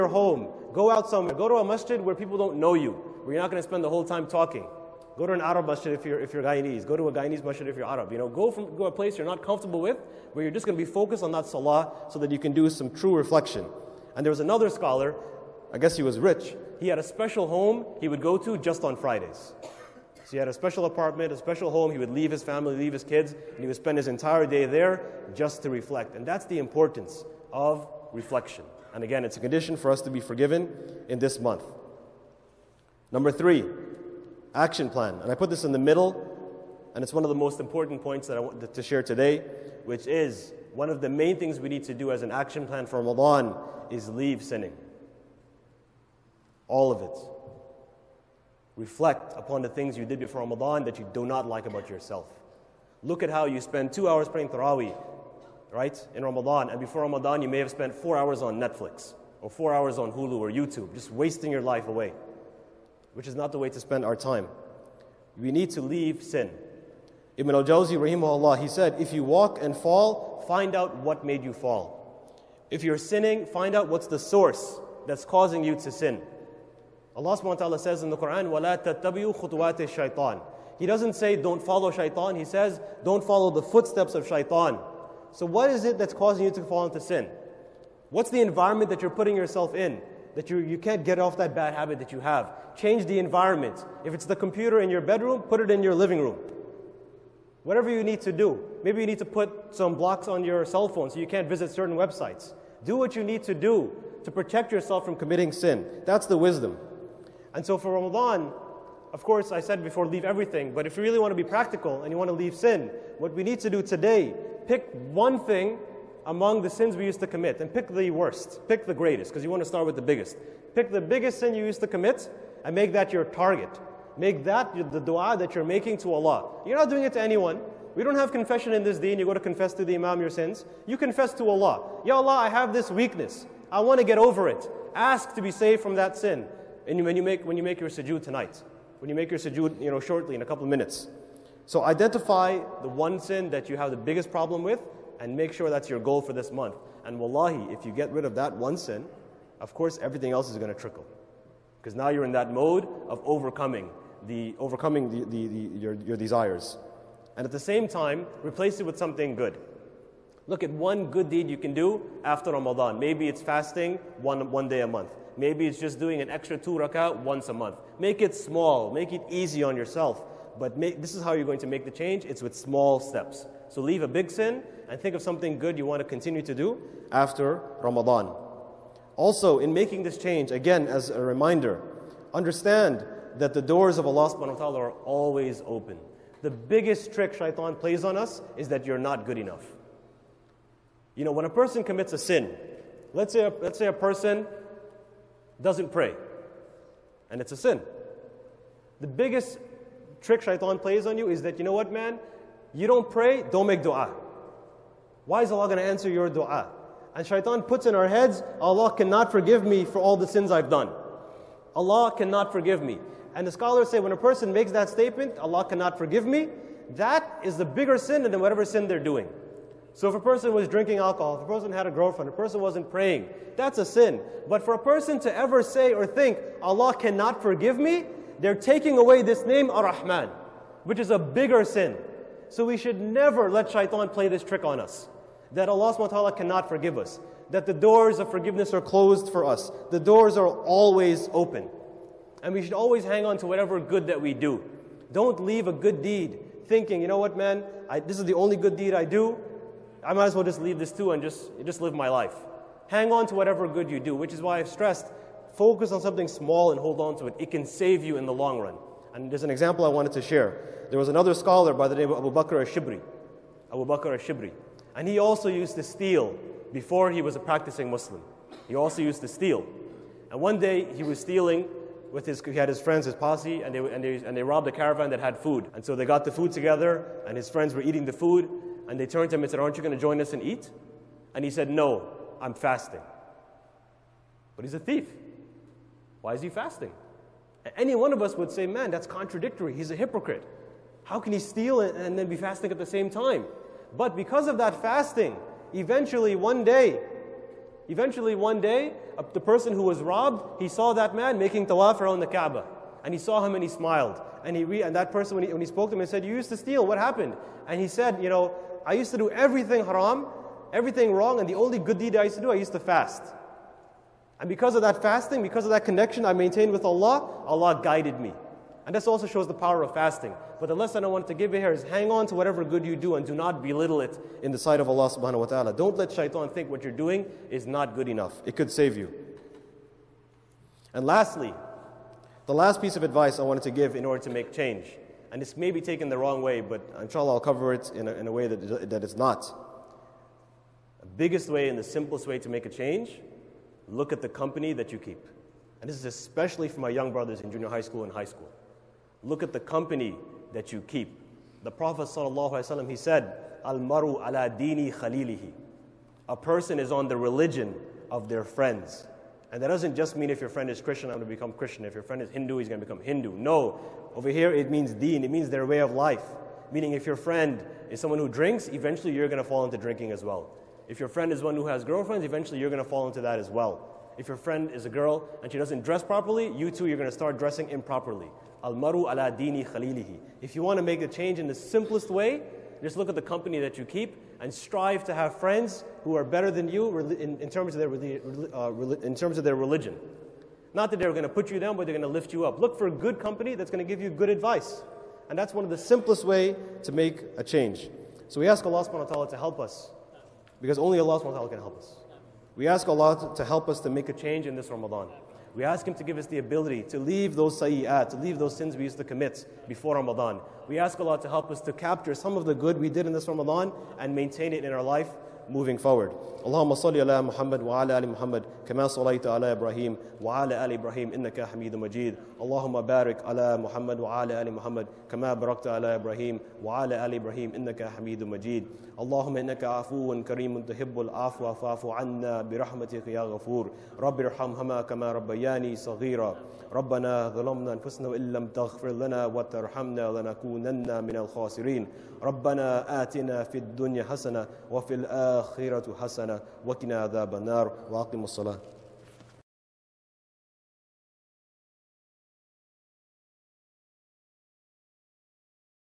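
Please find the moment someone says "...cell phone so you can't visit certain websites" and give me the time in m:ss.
1:40.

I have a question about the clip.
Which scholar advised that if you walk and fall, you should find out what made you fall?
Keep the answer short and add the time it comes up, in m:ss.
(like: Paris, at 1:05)
Ibn al Jawzi, at 1:07.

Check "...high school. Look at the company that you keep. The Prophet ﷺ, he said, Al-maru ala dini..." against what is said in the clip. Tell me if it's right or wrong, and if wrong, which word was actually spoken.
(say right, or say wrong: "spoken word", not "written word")
right.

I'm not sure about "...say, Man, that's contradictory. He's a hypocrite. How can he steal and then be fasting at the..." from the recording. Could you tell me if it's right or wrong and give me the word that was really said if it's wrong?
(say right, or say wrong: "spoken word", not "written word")
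right.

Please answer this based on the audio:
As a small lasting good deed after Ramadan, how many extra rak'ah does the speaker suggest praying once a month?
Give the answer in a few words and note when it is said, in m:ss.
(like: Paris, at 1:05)
2, at 2:46.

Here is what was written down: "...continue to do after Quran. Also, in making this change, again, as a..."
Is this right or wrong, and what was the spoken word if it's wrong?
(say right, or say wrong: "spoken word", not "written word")
wrong: "Ramadan", not "Quran".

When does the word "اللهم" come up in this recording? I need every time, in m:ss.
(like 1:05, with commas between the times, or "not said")
6:56, 7:02, 7:08.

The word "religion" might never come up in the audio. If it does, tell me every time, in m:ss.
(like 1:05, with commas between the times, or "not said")
5:57, 6:29.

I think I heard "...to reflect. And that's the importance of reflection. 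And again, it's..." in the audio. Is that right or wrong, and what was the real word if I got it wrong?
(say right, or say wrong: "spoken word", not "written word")
right.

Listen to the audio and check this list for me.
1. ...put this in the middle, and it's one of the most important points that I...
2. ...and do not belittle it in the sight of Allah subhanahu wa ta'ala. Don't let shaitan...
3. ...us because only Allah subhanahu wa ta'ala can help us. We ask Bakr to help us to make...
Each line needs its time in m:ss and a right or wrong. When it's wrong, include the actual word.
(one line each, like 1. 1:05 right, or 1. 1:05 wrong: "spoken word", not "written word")
1. 0:35 right
2. 5:23 right
3. 6:39 wrong: "Allah", not "Bakr".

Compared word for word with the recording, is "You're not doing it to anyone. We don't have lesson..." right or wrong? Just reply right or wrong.
wrong.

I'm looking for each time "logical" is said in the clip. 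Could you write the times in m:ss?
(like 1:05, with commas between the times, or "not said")
not said.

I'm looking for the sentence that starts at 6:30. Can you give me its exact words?
Not that they're going to put you down, but they're going to lift you up.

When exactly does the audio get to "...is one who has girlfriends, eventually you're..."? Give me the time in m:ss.
6:11.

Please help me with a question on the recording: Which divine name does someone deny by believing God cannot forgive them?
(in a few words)
Ar-Rahman.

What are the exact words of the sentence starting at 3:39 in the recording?
So if a person was drinking alcohol, if a person had a girlfriend, if a person wasn't praying, that's a sin.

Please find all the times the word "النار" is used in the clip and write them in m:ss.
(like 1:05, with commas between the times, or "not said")
7:27.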